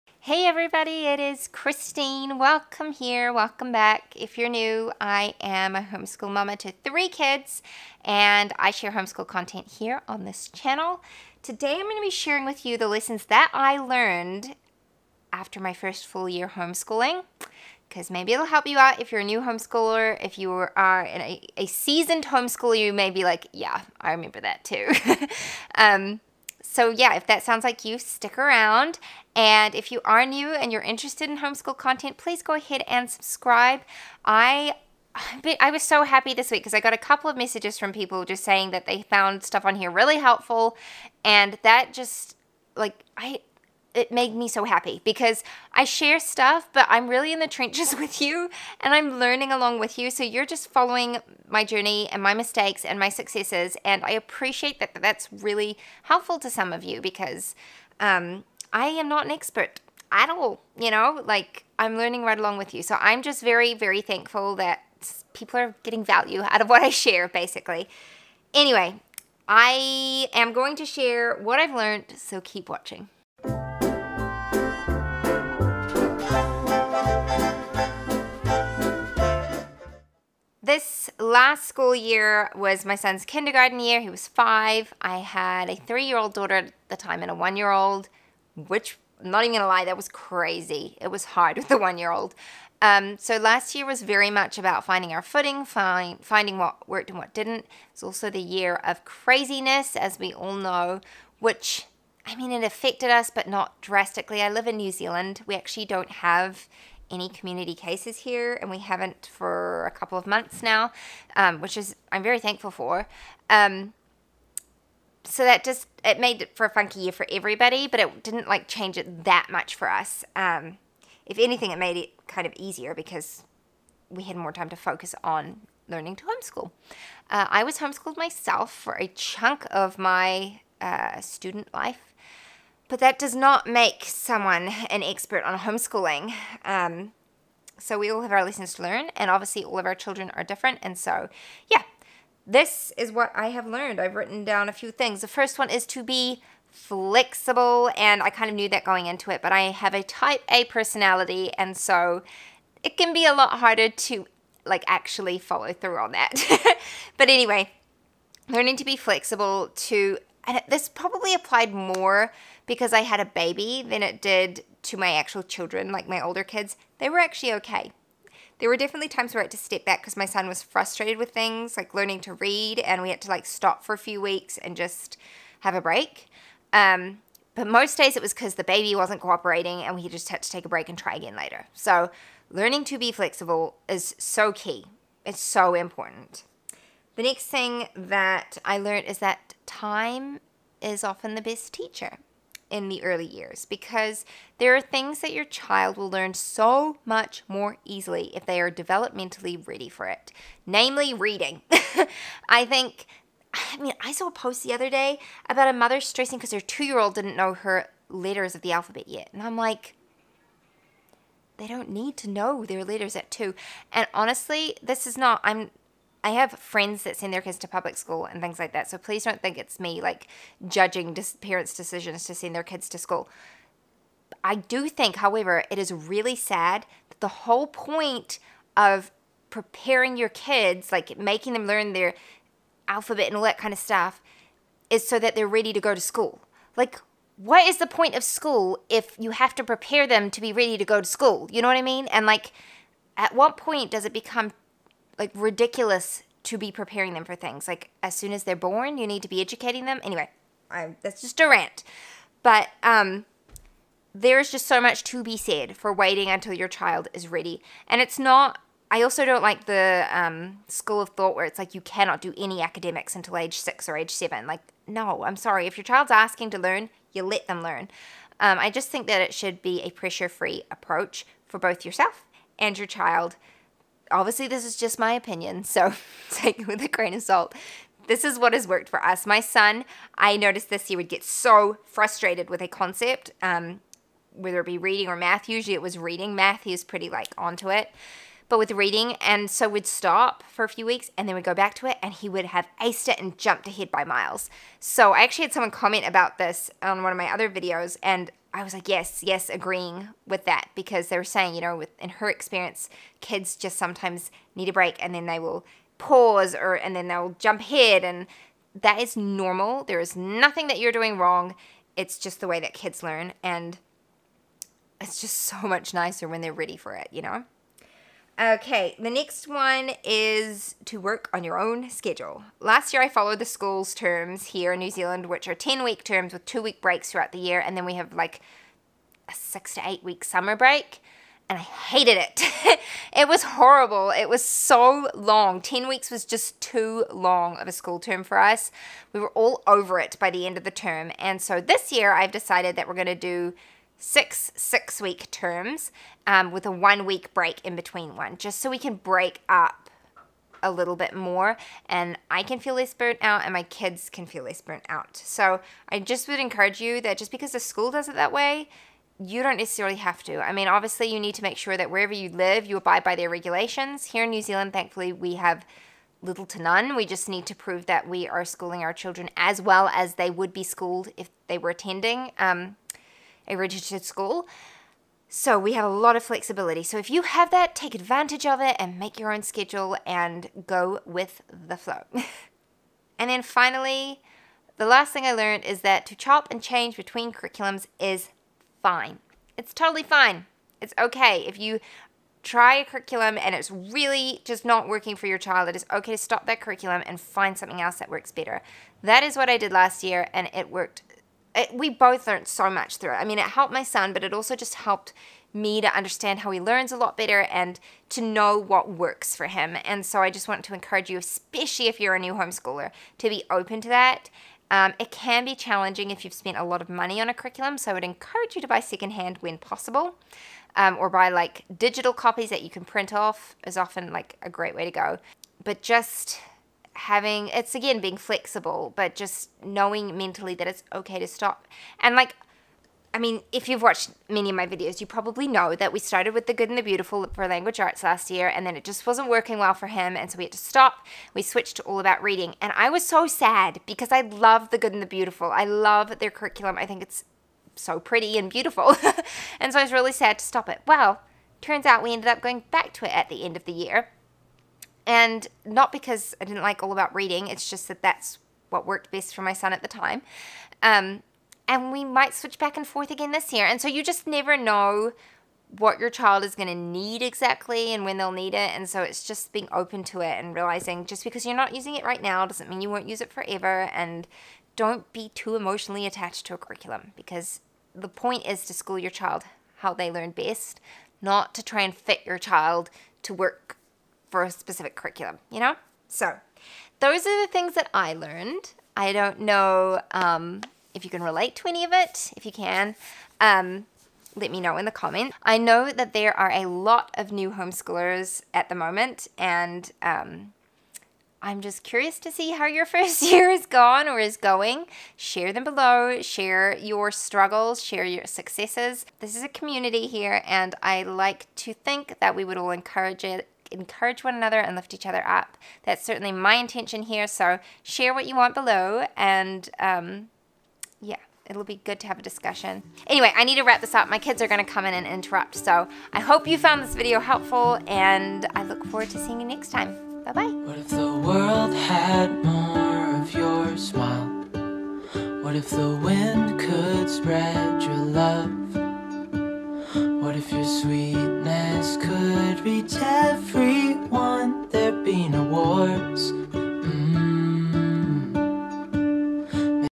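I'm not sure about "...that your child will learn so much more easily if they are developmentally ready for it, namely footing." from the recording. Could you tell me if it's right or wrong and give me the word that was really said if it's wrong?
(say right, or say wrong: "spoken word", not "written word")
wrong: "reading", not "footing".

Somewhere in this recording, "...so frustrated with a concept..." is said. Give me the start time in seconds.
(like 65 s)
281 s.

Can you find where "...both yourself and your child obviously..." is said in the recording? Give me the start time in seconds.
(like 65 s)
271 s.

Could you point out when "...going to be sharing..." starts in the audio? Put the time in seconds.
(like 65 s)
11 s.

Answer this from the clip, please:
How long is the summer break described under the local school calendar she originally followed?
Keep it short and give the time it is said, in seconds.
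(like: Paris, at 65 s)
6 to 8 weeks, at 329 s.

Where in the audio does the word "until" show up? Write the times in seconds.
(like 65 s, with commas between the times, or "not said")
256 s, 263 s.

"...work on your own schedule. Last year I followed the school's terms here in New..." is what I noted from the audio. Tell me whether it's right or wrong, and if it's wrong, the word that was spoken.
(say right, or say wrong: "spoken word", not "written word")
right.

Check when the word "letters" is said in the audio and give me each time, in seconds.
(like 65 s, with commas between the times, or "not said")
208 s, 212 s.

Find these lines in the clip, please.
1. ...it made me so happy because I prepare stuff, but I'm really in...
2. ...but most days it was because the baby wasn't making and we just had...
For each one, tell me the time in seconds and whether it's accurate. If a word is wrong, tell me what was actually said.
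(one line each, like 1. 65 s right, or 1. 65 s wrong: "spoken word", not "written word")
1. 43 s wrong: "share", not "prepare"
2. 177 s wrong: "cooperating", not "making".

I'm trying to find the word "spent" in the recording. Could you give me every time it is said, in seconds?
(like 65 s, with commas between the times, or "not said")
416 s.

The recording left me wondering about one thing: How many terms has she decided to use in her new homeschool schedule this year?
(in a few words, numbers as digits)
6.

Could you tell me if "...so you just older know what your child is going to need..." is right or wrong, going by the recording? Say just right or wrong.
wrong.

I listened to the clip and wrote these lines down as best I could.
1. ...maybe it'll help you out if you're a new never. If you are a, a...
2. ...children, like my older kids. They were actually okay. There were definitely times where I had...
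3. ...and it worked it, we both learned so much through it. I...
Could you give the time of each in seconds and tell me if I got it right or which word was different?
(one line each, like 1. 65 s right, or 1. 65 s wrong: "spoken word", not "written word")
1. 18 s wrong: "homeschooler", not "never"
2. 165 s right
3. 400 s right.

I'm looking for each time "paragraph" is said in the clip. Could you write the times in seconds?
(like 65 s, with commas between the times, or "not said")
not said.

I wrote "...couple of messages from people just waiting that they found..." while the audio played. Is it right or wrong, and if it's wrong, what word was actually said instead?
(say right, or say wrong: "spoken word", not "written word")
wrong: "saying", not "waiting".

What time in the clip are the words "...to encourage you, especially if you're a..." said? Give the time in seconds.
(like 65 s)
410 s.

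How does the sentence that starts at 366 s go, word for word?
We just need to prove that we are schooling our children as well as they would be schooled if they were attending.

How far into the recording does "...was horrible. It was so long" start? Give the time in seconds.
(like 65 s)
333 s.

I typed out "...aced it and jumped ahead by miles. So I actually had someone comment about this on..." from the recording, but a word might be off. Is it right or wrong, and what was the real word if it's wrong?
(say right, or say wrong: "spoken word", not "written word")
right.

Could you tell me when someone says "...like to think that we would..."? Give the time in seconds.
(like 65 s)
511 s.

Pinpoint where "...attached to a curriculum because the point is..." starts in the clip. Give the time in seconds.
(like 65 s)
476 s.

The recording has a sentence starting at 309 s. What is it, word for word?
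There is nothing that you're doing wrong.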